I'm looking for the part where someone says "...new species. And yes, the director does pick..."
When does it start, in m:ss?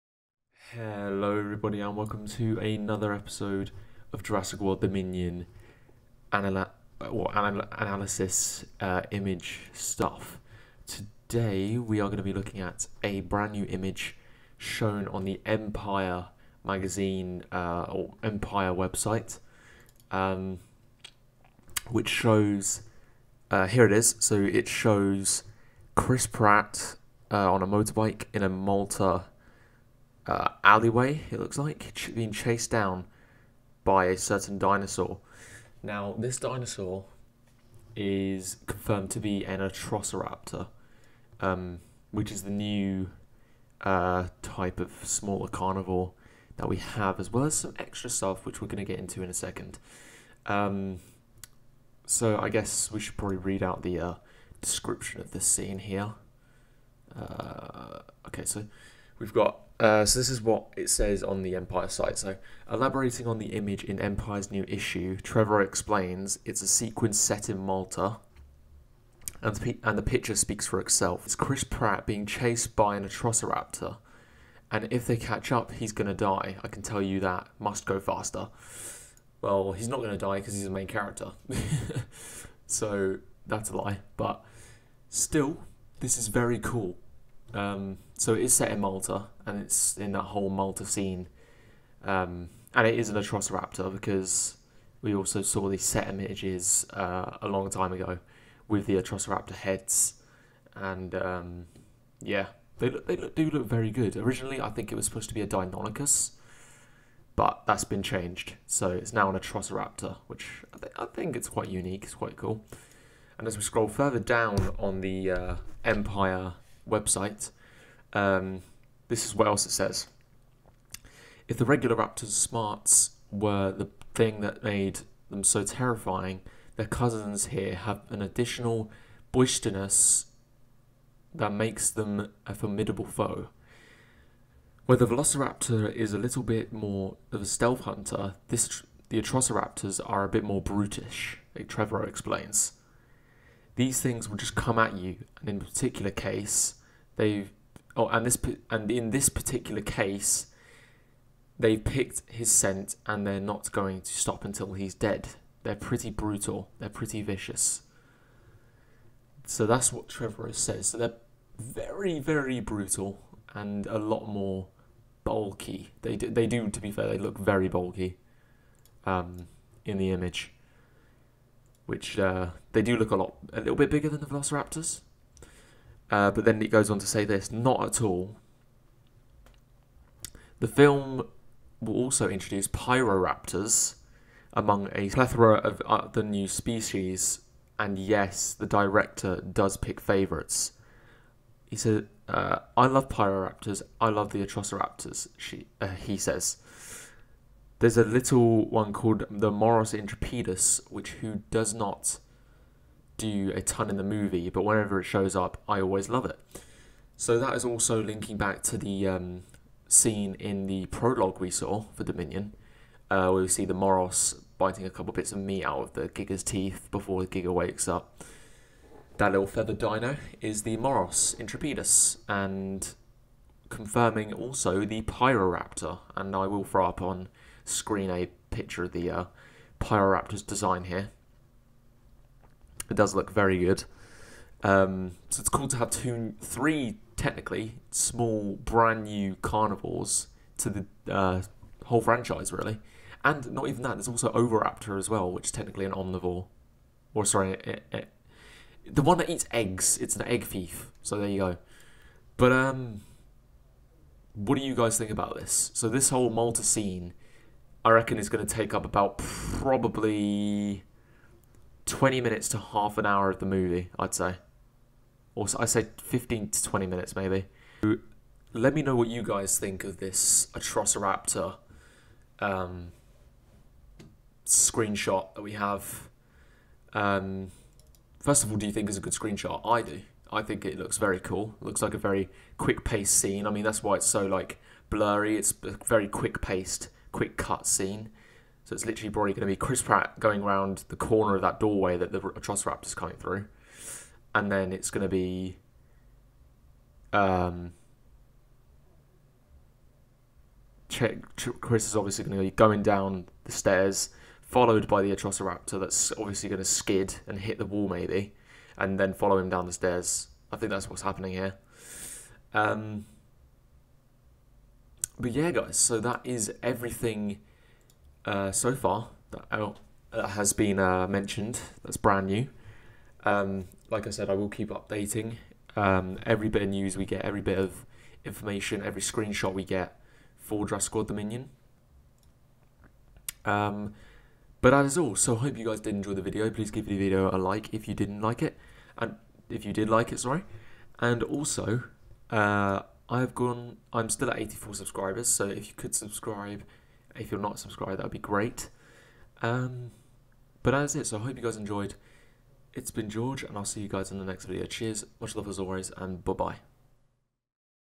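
3:06.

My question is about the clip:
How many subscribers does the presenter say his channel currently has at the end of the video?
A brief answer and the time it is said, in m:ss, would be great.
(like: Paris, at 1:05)
84, at 5:44.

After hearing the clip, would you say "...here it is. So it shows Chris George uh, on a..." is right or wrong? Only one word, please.
wrong.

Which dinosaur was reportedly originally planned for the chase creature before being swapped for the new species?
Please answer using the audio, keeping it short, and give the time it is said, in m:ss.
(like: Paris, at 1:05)
Deinonychus, at 1:45.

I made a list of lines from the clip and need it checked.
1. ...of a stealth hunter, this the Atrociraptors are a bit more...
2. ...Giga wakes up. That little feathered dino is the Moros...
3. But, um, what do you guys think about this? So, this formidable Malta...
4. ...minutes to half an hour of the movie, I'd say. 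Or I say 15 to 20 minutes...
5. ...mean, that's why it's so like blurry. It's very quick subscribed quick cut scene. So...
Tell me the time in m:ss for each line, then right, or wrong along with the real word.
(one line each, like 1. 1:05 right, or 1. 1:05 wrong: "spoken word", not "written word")
1. 2:17 right
2. 3:37 right
3. 4:12 wrong: "whole", not "formidable"
4. 4:22 right
5. 4:43 wrong: "paced", not "subscribed".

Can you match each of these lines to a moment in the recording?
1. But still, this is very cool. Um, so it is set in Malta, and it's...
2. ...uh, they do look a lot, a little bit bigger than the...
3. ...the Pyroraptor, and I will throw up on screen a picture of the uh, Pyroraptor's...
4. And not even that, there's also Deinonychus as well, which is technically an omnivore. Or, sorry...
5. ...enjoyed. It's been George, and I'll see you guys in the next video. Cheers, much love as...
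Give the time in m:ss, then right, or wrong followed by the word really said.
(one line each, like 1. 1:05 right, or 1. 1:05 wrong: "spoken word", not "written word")
1. 1:24 right
2. 2:52 right
3. 3:44 right
4. 4:03 wrong: "Oviraptor", not "Deinonychus"
5. 5:51 right.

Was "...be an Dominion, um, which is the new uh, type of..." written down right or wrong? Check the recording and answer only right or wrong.
wrong.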